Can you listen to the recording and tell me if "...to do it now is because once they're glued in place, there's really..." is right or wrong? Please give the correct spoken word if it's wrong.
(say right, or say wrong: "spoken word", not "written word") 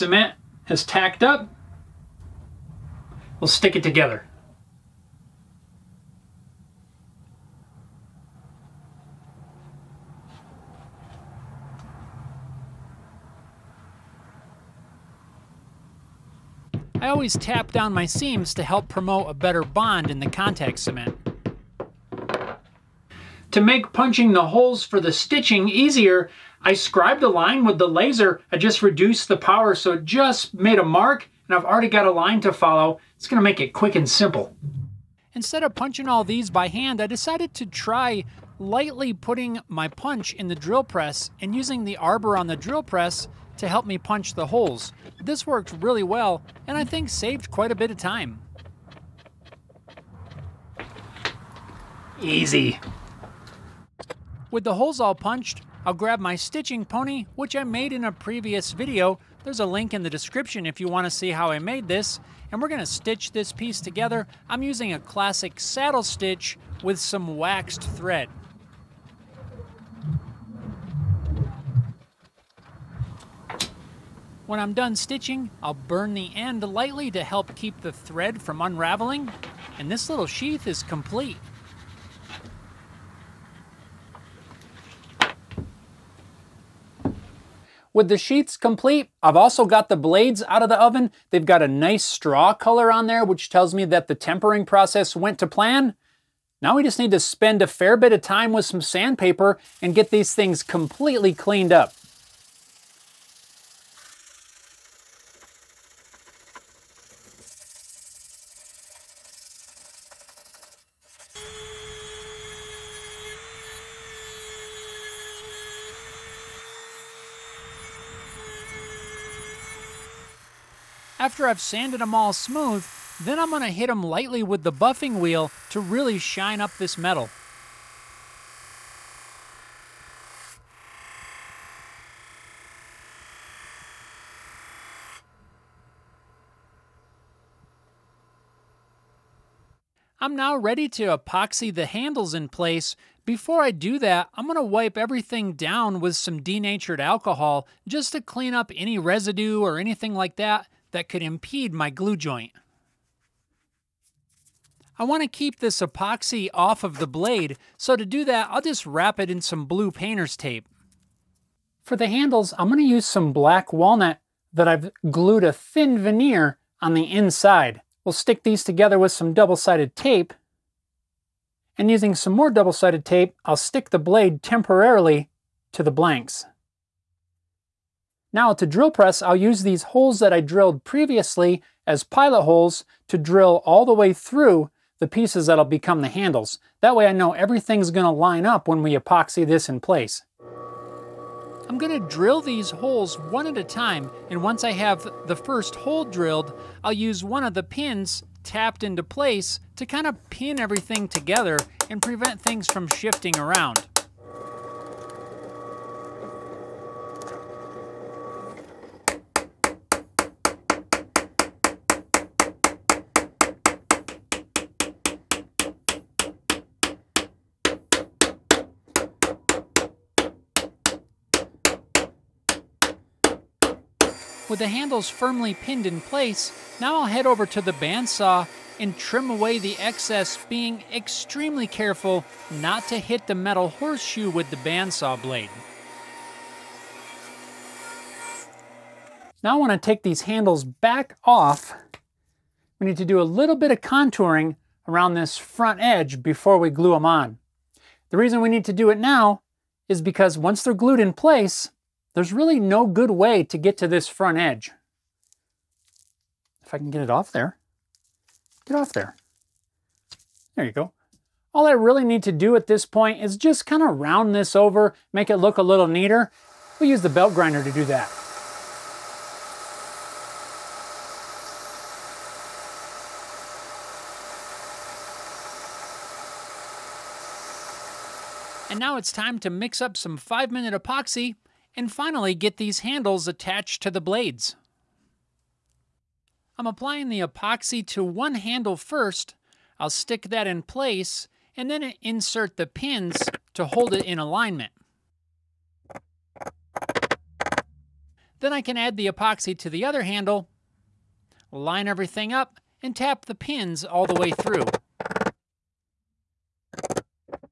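right.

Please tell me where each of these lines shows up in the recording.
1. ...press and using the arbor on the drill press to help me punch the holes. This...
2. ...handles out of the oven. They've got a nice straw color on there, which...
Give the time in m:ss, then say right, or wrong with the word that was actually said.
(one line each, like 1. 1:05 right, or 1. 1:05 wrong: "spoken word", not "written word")
1. 0:40 right
2. 1:29 wrong: "blades", not "handles".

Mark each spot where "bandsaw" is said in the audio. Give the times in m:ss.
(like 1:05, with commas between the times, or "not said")
3:47, 3:54.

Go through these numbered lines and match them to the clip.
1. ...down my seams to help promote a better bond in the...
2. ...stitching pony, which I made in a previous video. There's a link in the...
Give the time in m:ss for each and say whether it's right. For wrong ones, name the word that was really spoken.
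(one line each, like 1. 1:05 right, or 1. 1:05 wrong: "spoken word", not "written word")
1. 0:17 right
2. 0:56 right.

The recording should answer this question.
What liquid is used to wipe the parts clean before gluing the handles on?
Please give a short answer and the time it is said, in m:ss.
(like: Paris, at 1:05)
denatured alcohol, at 2:26.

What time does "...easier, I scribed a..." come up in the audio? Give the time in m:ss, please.
0:25.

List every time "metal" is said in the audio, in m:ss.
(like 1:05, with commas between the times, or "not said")
2:06, 3:53.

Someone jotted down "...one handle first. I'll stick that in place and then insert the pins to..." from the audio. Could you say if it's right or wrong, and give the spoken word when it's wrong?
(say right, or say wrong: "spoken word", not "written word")
right.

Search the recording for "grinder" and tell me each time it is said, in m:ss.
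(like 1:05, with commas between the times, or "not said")
4:27.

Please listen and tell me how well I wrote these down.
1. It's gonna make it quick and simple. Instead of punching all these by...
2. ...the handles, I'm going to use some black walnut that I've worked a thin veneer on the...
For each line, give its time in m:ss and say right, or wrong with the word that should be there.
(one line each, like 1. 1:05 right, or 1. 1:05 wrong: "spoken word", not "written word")
1. 0:33 right
2. 2:41 wrong: "glued", not "worked".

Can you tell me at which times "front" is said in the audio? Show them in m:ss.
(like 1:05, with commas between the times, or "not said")
4:05, 4:14.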